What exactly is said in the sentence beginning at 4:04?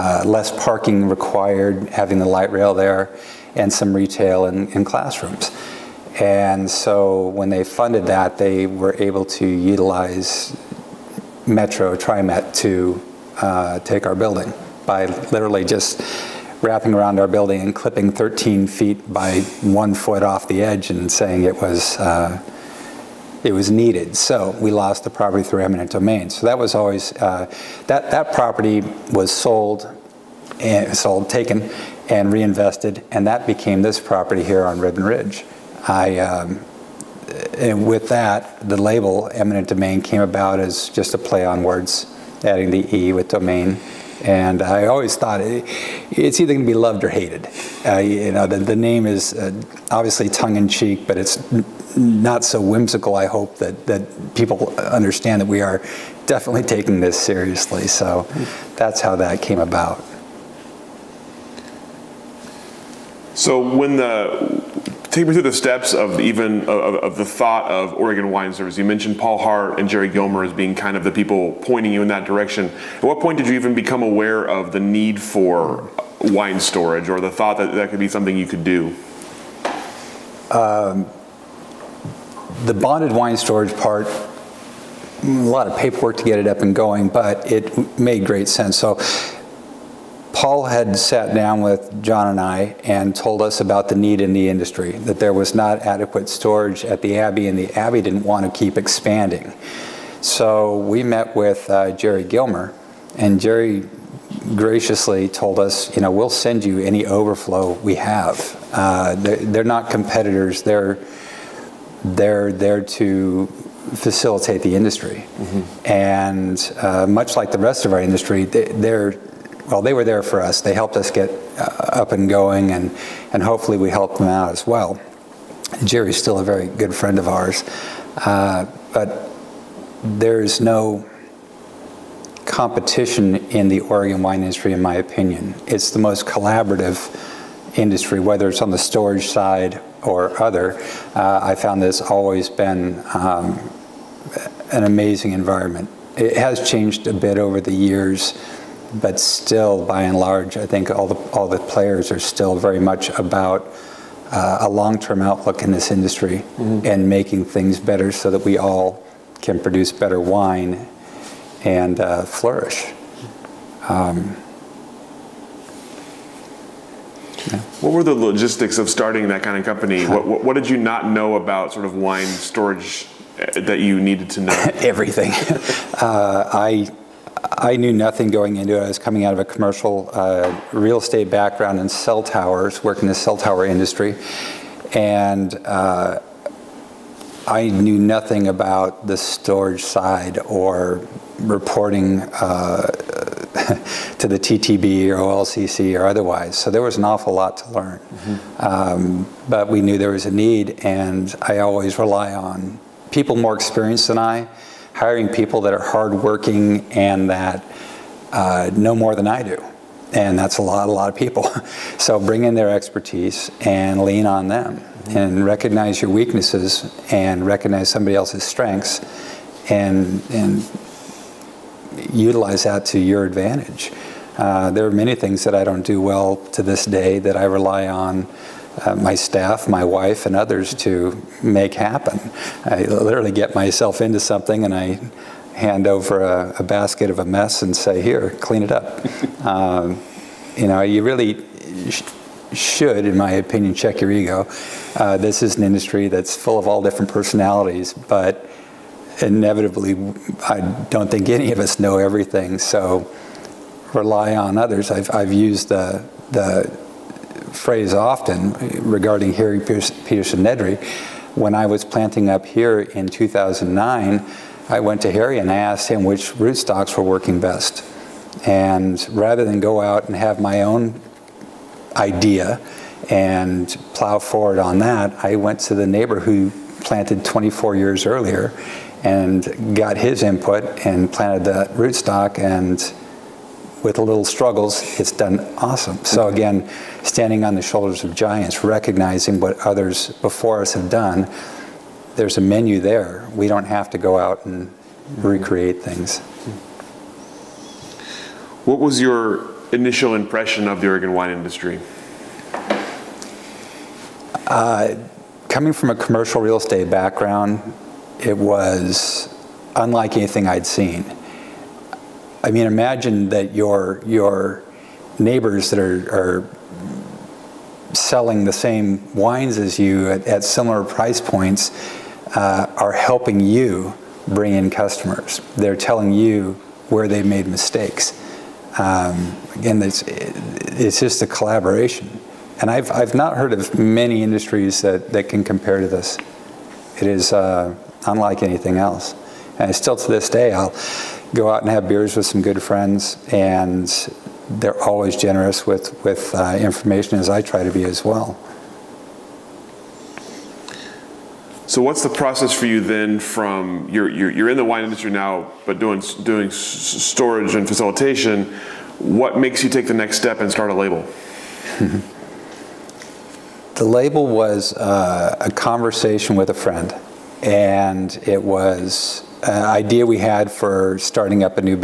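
Uh, this is an industry that's full of all different personalities, but inevitably, I don't think any of us know everything.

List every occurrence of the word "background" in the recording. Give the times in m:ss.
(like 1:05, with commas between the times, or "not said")
3:01, 5:06.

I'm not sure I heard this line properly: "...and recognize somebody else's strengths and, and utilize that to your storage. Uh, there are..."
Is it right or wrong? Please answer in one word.
wrong.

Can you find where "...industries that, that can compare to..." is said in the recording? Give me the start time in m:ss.
5:34.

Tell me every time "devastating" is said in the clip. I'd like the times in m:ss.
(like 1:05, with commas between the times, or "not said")
not said.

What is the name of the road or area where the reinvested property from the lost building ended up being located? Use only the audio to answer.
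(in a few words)
Ribbon Ridge.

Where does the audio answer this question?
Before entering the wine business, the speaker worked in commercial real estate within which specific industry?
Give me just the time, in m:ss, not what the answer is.
3:01.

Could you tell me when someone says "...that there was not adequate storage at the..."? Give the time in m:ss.
1:34.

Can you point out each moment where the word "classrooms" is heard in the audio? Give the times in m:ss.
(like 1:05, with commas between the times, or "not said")
0:04.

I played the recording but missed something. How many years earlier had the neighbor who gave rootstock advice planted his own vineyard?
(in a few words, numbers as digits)
24.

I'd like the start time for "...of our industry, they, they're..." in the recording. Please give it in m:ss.
1:57.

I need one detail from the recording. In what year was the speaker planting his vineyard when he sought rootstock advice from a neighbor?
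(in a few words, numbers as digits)
2009.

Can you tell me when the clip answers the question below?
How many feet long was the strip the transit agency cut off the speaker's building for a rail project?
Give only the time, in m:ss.
0:18.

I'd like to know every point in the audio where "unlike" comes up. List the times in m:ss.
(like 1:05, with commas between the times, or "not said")
5:09, 5:38.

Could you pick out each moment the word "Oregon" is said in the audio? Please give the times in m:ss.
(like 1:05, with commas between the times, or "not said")
1:07, 2:13, 5:00.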